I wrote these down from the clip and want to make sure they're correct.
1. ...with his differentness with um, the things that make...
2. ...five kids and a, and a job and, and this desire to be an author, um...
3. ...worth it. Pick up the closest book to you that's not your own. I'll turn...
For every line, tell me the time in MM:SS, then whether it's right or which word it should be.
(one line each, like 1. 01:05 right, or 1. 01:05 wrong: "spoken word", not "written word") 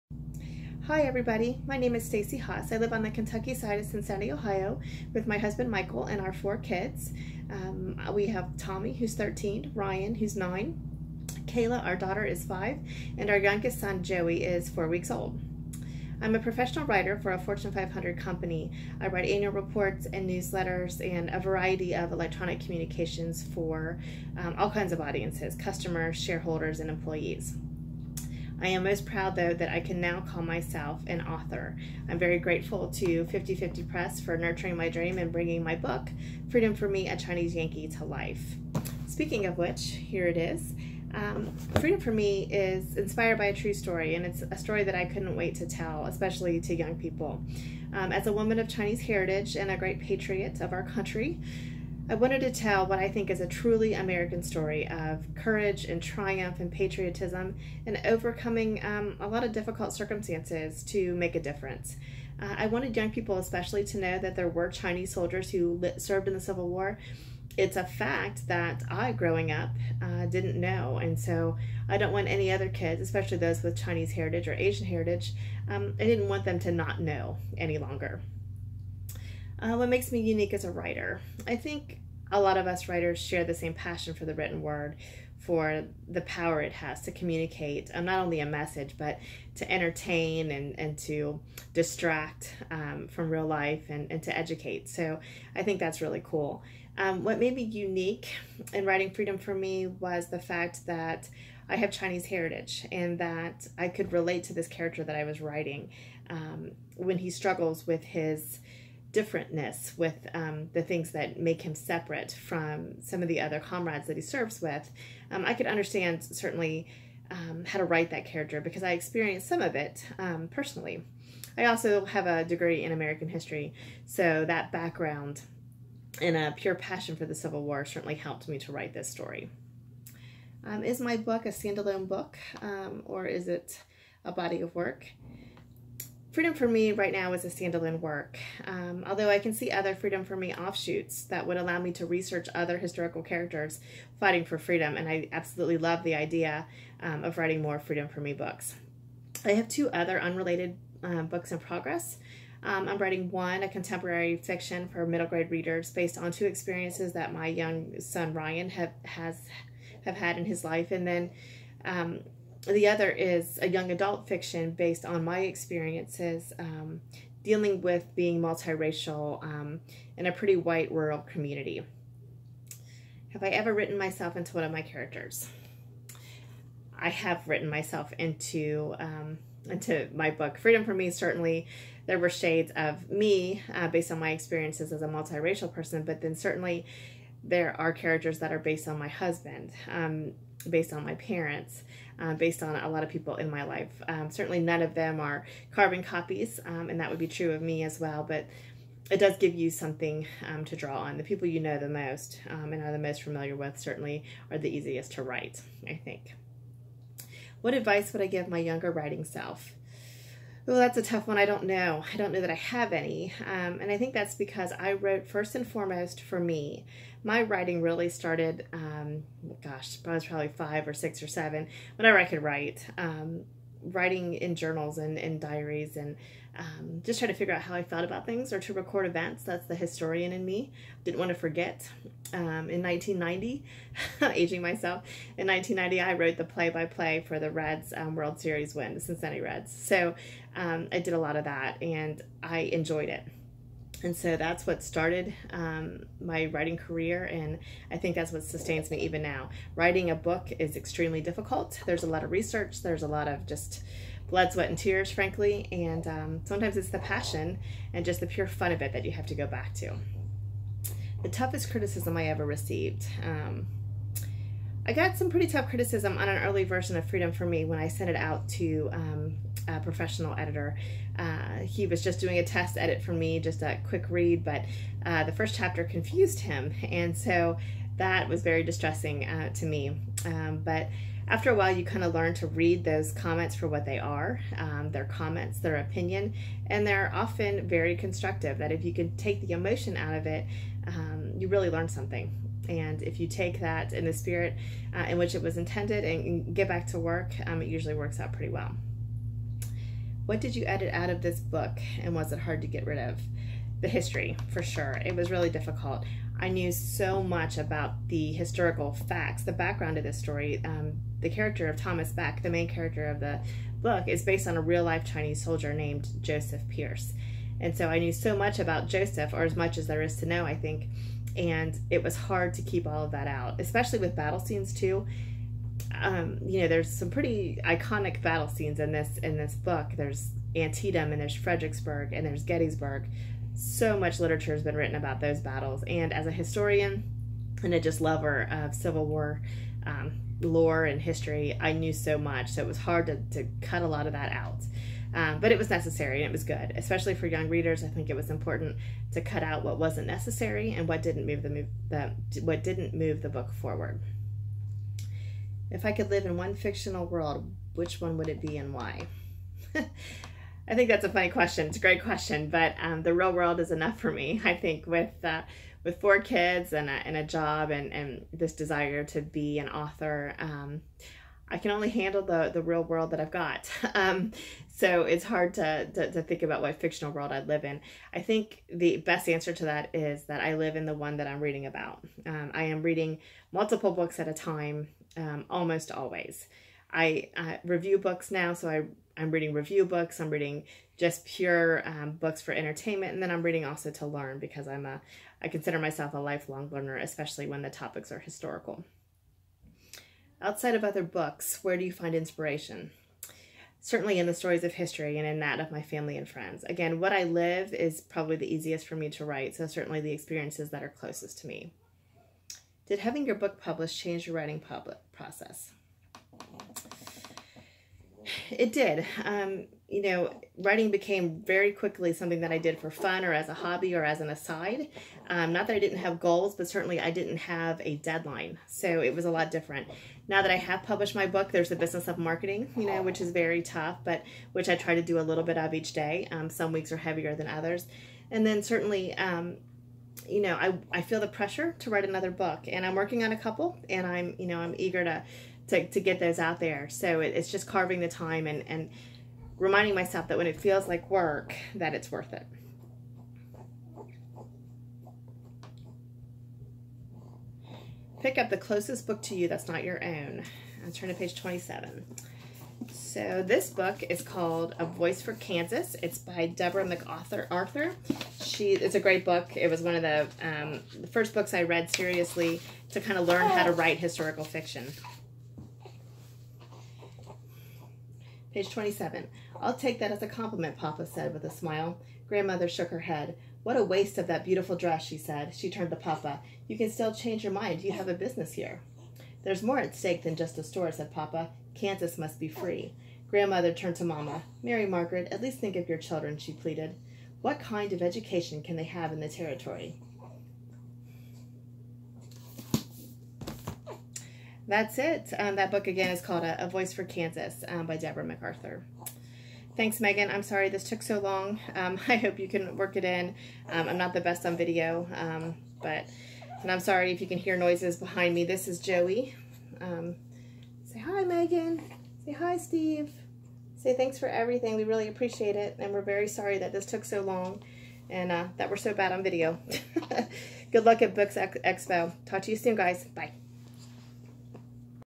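1. 01:47 right
2. 06:05 wrong: "four", not "five"
3. 07:32 right.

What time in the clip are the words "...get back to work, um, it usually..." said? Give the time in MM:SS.
04:56.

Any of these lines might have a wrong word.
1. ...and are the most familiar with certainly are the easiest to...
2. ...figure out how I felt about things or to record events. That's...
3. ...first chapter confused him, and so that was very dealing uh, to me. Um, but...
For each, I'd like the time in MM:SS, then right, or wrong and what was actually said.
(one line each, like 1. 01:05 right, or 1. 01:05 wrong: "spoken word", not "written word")
1. 03:22 right
2. 03:47 right
3. 04:35 wrong: "distressing", not "dealing".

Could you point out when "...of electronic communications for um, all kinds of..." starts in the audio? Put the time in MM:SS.
00:21.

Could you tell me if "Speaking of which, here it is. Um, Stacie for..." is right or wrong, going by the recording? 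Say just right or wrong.
wrong.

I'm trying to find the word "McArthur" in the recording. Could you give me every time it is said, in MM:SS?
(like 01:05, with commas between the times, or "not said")
07:46, 08:28.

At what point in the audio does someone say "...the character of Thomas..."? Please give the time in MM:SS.
05:11.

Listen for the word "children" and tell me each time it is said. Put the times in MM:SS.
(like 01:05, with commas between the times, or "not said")
08:15.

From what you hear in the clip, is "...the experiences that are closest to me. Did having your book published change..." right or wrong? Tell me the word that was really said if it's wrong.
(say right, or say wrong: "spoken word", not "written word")
right.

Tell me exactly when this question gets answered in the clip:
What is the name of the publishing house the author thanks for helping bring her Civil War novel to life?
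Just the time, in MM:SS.
00:33.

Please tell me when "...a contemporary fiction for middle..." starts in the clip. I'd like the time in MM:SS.
02:33.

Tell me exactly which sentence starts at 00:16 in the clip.
I'm a professional writer for a Fortune 500 company.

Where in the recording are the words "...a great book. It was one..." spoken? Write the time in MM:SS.
07:48.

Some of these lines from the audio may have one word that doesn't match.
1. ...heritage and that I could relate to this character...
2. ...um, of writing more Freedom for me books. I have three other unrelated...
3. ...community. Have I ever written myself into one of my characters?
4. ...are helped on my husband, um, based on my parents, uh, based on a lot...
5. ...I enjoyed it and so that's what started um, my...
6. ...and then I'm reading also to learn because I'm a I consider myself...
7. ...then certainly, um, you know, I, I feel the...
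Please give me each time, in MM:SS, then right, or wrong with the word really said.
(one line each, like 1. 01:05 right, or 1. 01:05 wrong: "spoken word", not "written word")
1. 01:42 right
2. 02:27 wrong: "two", not "three"
3. 02:51 right
4. 03:08 wrong: "based", not "helped"
5. 04:02 right
6. 06:33 right
7. 07:18 right.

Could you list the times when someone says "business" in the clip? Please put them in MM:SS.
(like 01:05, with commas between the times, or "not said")
07:11, 08:08.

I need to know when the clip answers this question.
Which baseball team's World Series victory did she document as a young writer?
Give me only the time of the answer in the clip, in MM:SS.
03:58.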